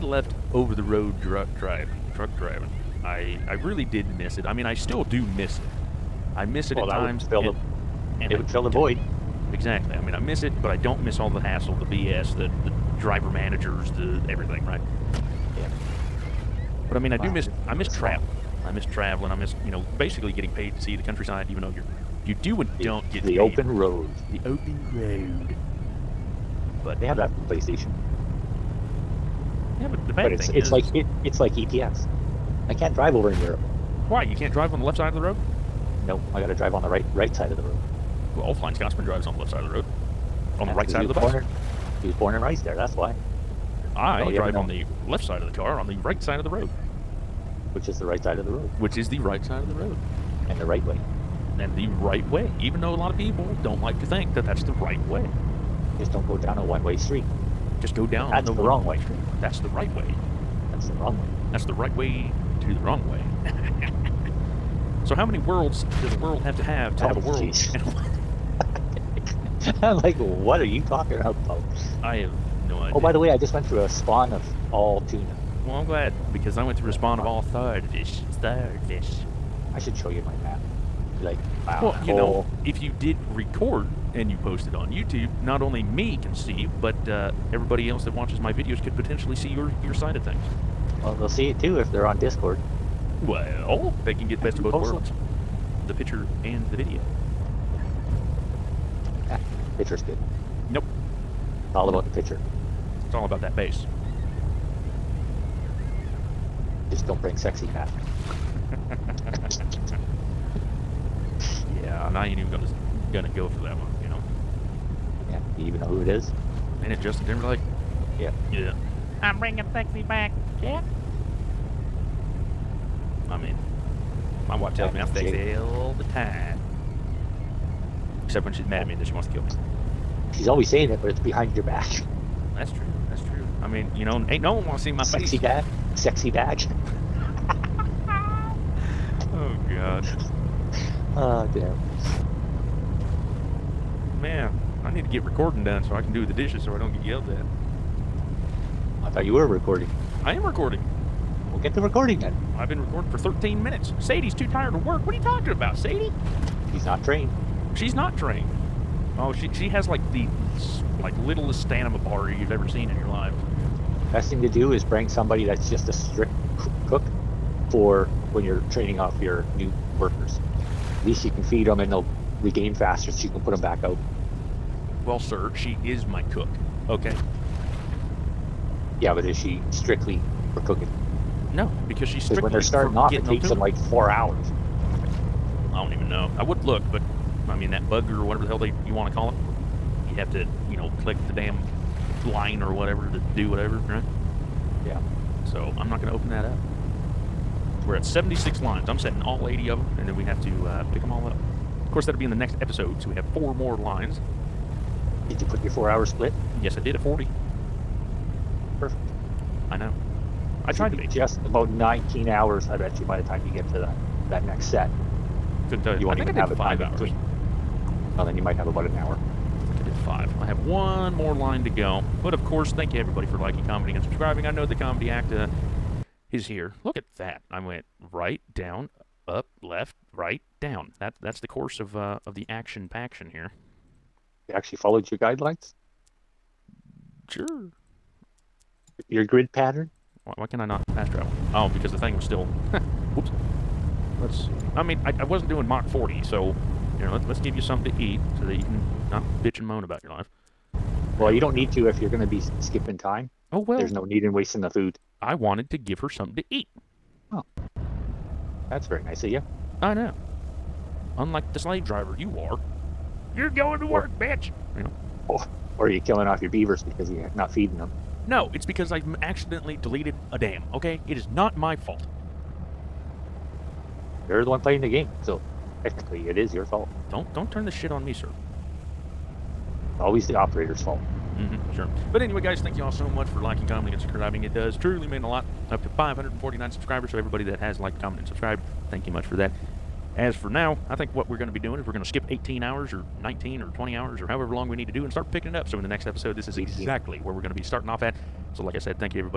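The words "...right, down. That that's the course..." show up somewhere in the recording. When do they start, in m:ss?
3:50.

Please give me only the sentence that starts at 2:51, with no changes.
At least you can feed them and they'll regain faster so you can put them back out.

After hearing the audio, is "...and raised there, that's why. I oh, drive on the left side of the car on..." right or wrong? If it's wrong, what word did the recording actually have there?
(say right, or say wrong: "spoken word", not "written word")
right.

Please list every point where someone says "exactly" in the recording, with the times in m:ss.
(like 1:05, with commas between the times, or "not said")
0:09, 4:56.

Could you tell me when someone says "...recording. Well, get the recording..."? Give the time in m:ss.
2:30.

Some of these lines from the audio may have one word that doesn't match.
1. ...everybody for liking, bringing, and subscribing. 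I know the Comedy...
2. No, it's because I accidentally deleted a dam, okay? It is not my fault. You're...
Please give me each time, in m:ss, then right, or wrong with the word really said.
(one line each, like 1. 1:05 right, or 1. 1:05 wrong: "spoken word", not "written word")
1. 3:42 wrong: "commenting", not "bringing"
2. 4:28 right.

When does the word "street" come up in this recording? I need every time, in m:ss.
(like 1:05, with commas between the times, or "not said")
0:56.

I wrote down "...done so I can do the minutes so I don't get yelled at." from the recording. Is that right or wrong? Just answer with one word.
wrong.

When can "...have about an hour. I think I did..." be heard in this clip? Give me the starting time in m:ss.
3:38.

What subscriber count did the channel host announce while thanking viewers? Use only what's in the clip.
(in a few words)
549.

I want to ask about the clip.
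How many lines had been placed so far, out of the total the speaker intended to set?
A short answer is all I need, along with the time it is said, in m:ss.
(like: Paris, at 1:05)
76, at 3:18.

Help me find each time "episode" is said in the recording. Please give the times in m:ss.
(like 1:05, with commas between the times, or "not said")
3:22, 4:56.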